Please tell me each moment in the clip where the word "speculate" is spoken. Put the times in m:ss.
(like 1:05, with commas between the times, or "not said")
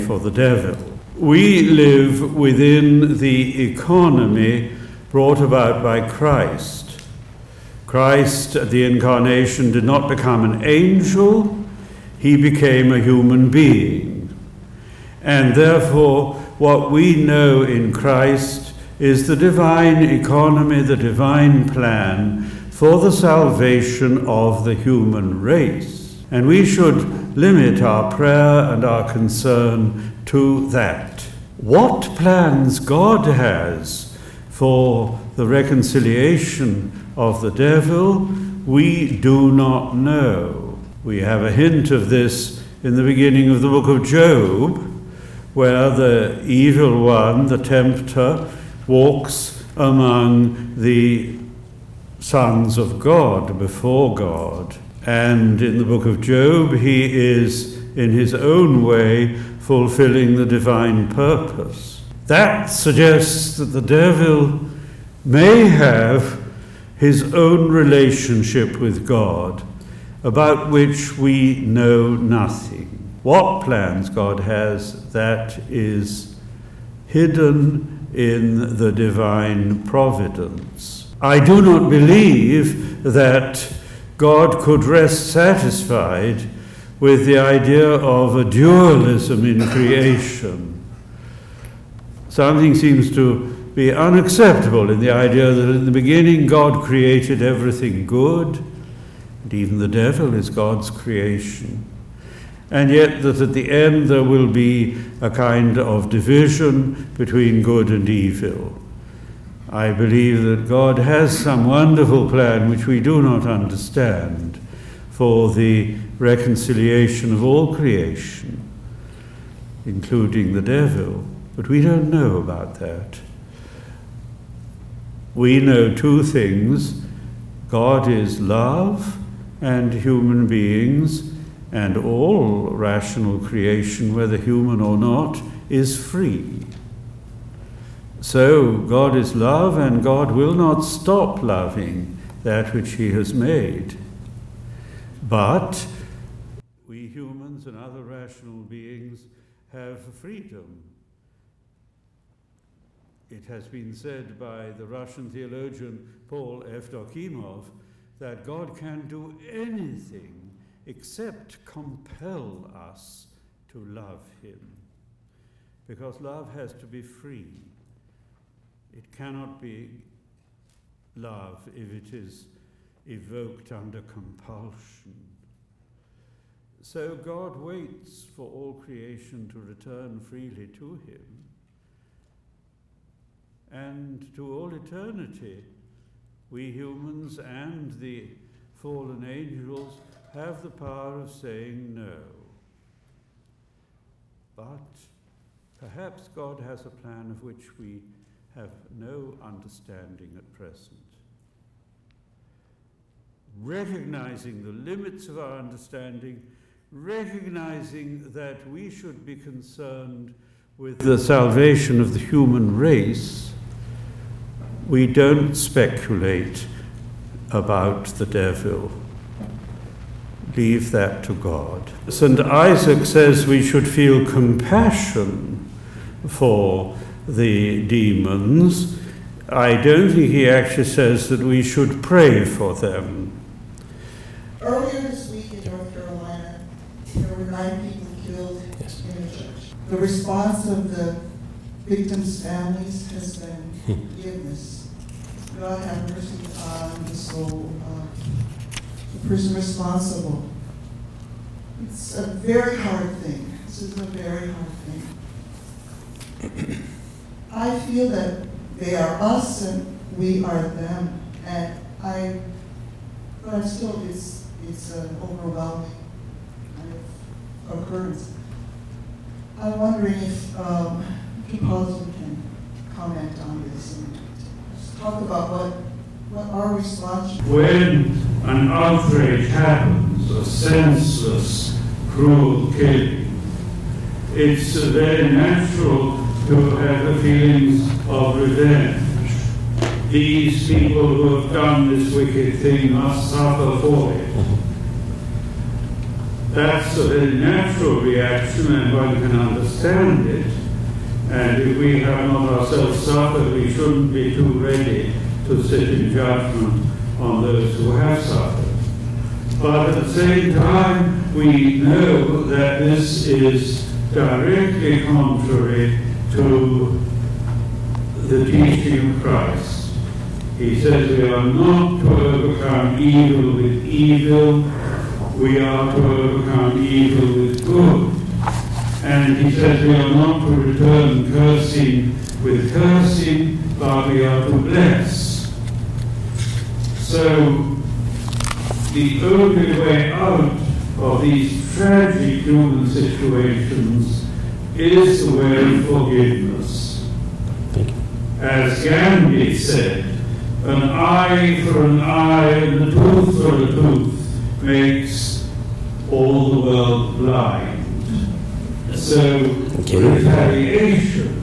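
3:35.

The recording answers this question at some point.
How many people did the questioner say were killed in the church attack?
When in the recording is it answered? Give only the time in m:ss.
3:57.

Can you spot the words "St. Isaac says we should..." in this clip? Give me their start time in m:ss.
3:42.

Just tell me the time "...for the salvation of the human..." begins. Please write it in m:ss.
0:22.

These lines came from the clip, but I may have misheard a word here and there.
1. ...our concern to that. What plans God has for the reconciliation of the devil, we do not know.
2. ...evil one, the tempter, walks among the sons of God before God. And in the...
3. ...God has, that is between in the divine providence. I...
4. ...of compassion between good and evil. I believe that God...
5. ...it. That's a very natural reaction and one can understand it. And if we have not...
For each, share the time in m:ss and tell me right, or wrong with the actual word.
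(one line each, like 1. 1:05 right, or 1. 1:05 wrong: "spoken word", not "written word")
1. 0:28 right
2. 0:46 right
3. 1:14 wrong: "hidden", not "between"
4. 1:45 wrong: "division", not "compassion"
5. 4:54 right.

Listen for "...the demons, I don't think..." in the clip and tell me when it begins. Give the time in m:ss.
3:47.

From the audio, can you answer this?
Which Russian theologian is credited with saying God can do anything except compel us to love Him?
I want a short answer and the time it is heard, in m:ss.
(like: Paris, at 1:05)
Paul Evdokimov, at 2:36.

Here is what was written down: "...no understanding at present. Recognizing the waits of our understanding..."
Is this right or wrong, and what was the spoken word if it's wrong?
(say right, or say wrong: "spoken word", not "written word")
wrong: "limits", not "waits".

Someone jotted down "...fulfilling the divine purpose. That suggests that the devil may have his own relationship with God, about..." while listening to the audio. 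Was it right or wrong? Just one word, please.
right.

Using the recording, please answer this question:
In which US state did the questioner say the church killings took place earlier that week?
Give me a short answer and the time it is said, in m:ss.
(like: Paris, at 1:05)
North Carolina, at 3:55.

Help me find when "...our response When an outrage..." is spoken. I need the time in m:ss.
4:36.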